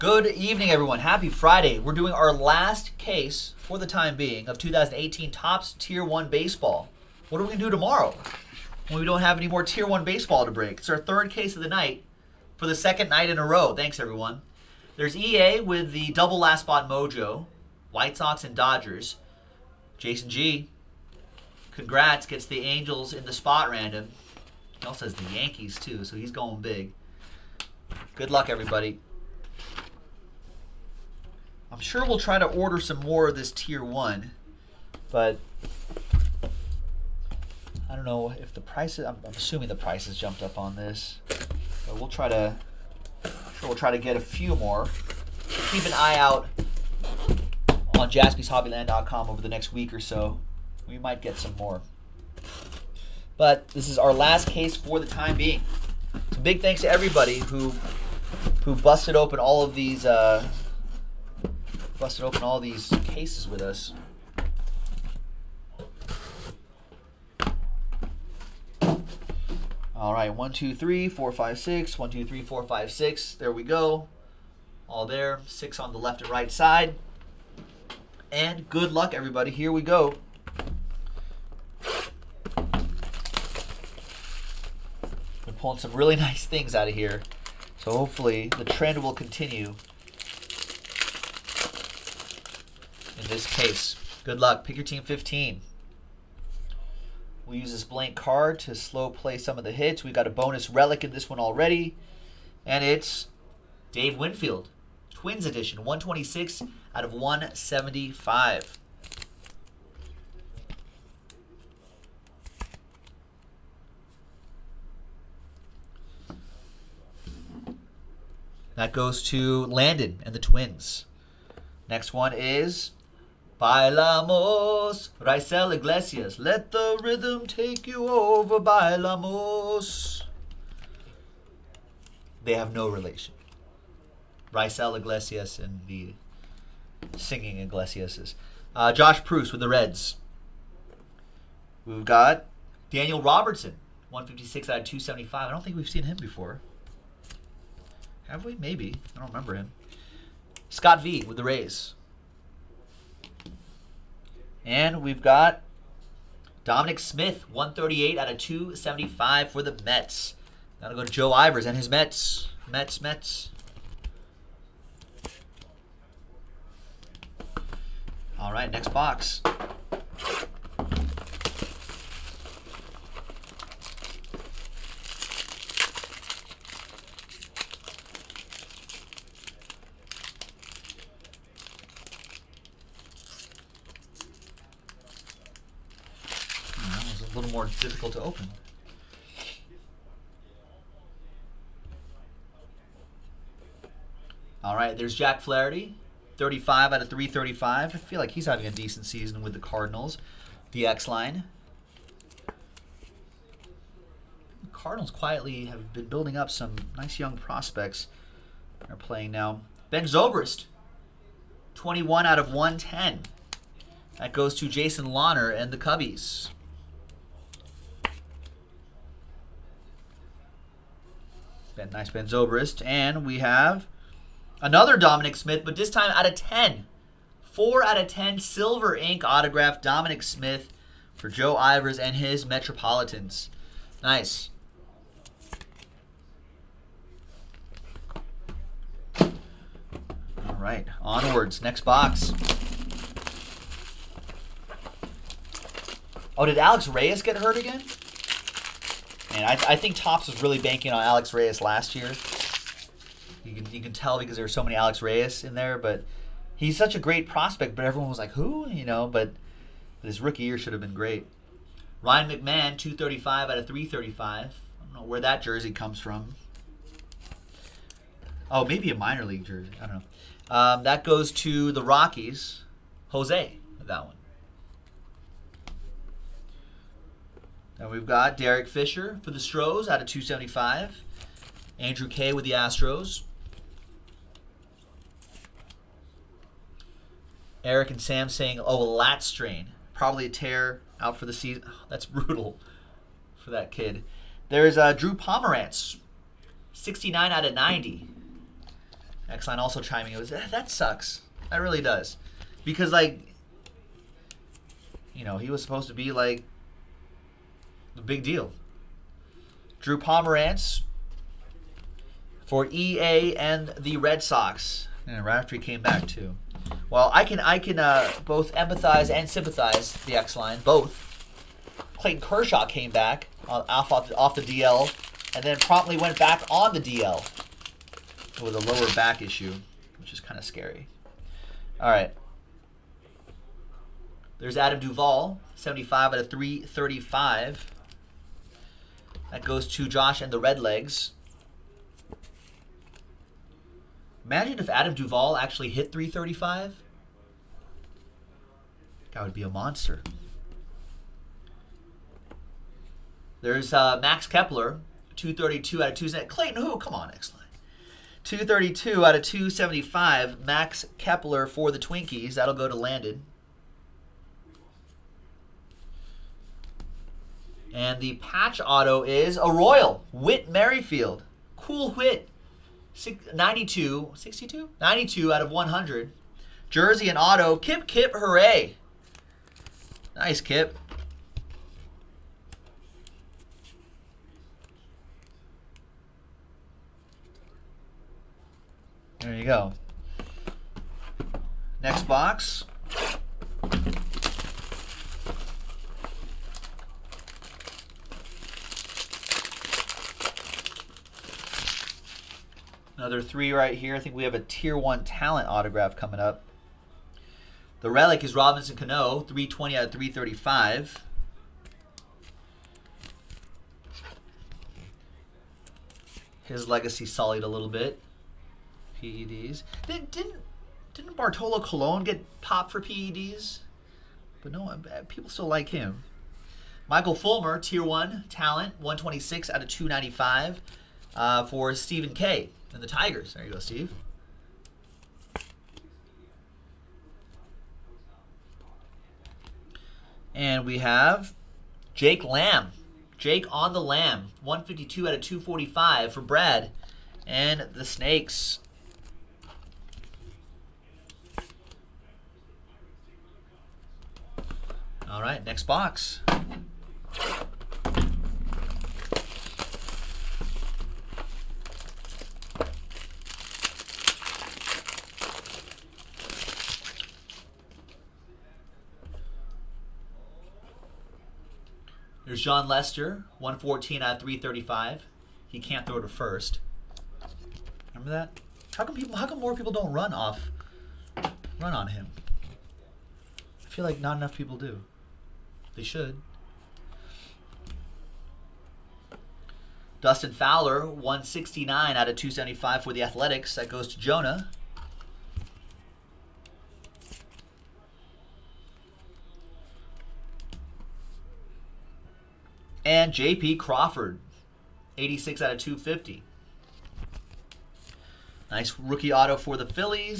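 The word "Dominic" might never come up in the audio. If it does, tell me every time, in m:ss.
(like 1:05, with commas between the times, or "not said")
2:36, 3:44, 3:49.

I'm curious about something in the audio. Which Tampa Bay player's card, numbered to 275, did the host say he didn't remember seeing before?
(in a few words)
Daniel Robertson.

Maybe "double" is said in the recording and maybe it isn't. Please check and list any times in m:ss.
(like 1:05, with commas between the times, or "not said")
0:16.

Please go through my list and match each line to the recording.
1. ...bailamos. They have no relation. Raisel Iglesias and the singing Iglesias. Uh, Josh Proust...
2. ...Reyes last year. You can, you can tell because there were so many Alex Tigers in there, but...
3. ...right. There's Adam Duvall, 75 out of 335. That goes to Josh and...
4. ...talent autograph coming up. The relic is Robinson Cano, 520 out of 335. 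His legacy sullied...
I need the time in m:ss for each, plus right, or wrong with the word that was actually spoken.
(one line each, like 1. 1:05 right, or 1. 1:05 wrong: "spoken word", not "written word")
1. 2:08 right
2. 4:11 wrong: "Reyes", not "Tigers"
3. 5:31 right
4. 6:45 wrong: "320", not "520".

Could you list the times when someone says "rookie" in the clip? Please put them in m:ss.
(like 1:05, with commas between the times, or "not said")
4:20, 8:28.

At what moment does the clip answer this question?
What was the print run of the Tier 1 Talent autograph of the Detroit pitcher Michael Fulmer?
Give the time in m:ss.
7:08.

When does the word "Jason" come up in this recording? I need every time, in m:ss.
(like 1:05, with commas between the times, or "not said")
0:19, 3:34.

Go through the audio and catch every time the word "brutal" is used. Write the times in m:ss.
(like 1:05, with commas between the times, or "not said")
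4:52.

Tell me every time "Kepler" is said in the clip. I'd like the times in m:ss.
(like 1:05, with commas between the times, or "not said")
5:54, 6:00.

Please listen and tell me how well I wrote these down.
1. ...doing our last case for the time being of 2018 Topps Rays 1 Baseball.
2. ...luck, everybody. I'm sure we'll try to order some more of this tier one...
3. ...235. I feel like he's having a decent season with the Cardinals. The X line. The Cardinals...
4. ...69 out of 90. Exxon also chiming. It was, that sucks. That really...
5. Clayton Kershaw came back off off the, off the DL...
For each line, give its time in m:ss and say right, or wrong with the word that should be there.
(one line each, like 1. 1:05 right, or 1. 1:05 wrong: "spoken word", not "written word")
1. 0:01 wrong: "Tier", not "Rays"
2. 0:28 right
3. 3:17 wrong: "335", not "235"
4. 4:56 right
5. 5:21 right.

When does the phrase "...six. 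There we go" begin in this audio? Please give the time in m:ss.
1:12.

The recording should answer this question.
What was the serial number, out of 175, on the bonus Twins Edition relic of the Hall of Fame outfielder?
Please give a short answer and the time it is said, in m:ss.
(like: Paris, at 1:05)
126, at 1:45.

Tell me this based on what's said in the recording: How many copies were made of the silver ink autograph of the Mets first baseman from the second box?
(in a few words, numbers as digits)
10.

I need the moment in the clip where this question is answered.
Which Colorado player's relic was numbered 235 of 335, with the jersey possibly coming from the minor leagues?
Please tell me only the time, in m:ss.
4:22.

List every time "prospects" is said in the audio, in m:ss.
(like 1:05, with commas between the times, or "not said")
3:27, 4:17.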